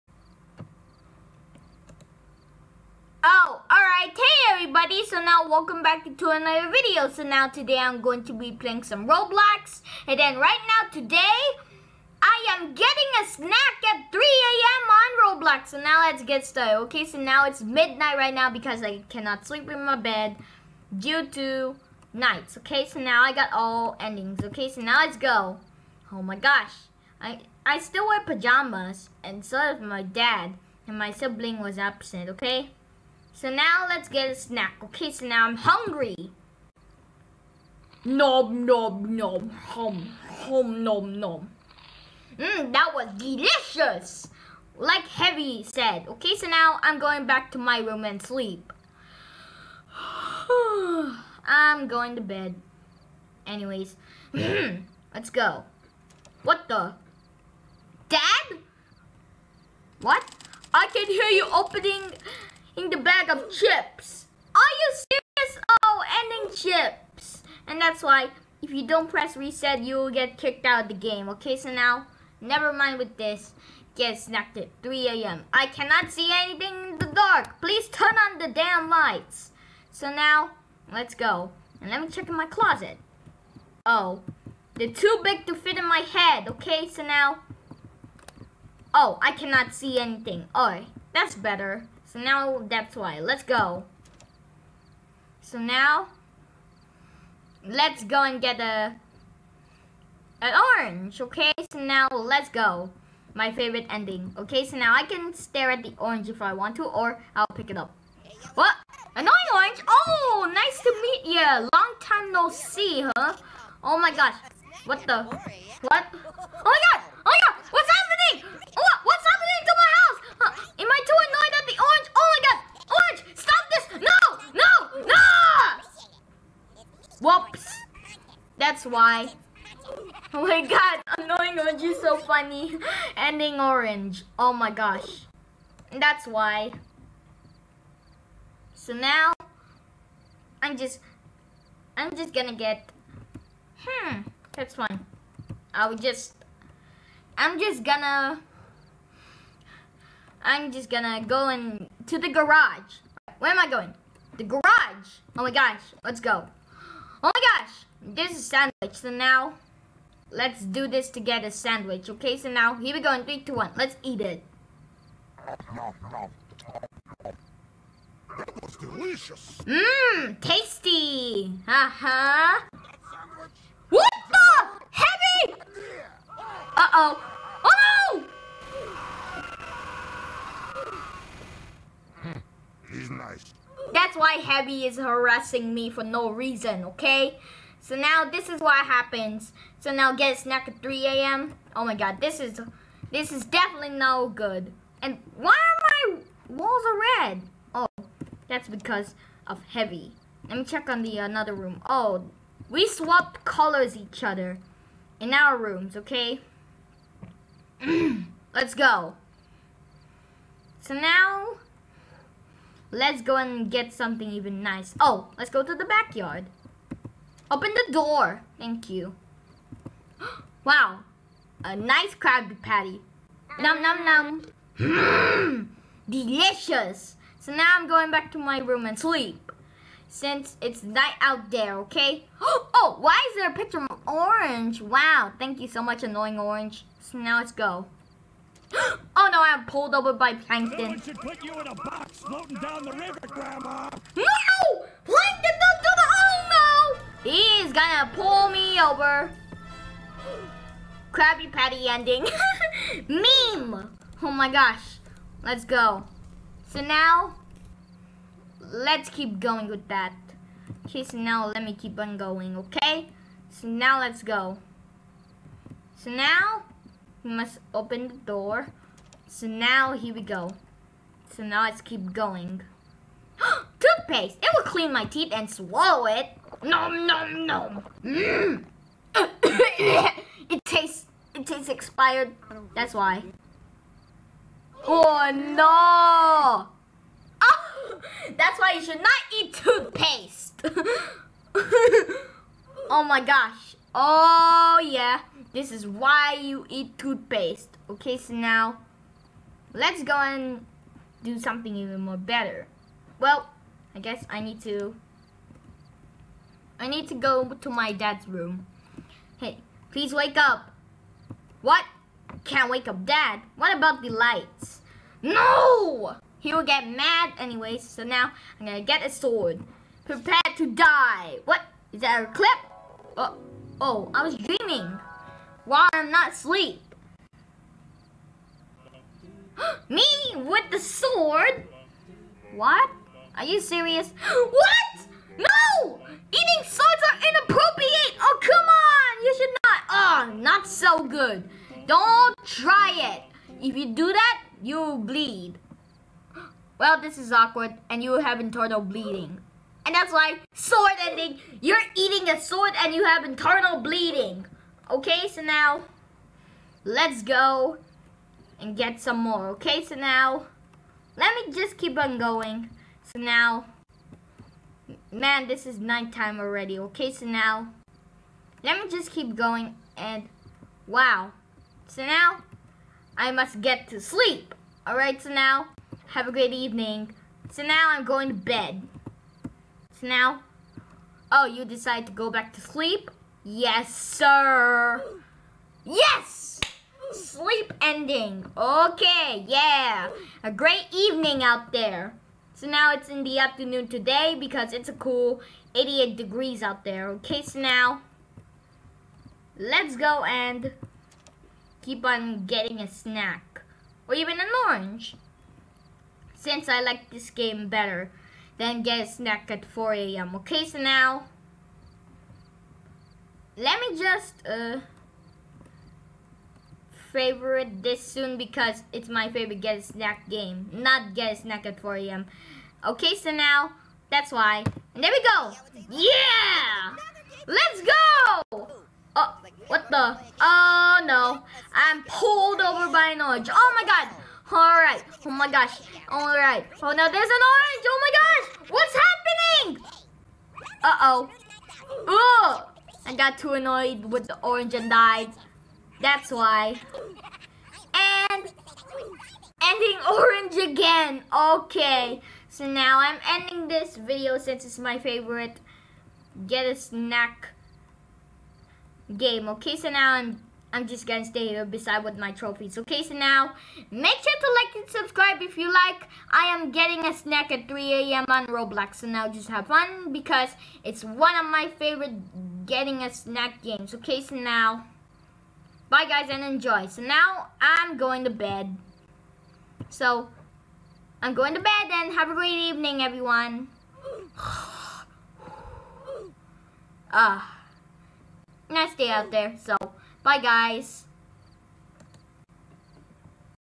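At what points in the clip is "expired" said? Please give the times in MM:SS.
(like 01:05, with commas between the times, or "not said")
04:41.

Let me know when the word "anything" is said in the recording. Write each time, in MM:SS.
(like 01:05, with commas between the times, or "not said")
01:16, 01:29.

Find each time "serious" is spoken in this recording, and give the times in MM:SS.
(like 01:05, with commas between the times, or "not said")
01:05, 05:33.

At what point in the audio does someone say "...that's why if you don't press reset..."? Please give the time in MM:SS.
01:07.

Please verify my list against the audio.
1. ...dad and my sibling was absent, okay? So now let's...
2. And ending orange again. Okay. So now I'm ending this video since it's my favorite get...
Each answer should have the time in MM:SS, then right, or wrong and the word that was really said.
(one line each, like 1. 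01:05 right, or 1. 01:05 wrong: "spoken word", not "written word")
1. 00:30 right
2. 07:27 right.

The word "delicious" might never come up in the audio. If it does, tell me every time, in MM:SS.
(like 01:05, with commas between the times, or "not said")
00:43, 02:48, 03:46.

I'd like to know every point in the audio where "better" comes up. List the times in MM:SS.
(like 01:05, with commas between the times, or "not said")
01:31, 05:02, 06:47.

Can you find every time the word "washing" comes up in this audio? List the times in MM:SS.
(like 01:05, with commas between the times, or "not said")
not said.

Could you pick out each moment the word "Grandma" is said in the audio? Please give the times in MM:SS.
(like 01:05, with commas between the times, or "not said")
04:03.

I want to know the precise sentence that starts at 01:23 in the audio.
Oh, they're too big to fit in my head.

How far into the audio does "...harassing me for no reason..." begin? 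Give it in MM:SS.
03:04.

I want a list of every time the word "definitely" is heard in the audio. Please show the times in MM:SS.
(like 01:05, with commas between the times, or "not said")
03:13.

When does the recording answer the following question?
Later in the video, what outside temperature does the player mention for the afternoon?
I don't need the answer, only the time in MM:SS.
06:35.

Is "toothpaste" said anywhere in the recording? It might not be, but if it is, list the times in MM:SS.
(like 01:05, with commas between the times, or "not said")
04:33, 04:49, 04:56.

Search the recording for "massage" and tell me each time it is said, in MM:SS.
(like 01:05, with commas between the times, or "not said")
not said.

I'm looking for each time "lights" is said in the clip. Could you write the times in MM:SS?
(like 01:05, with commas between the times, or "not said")
01:18, 05:14.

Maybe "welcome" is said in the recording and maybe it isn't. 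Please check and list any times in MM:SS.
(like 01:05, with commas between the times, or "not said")
00:05.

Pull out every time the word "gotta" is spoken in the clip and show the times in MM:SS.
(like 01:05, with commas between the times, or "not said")
not said.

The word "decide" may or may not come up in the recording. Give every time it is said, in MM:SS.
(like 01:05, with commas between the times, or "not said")
06:21.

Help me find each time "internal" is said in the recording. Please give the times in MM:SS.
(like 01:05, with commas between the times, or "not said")
05:48, 05:53.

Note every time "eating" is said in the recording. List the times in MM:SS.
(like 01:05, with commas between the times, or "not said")
05:36, 05:51.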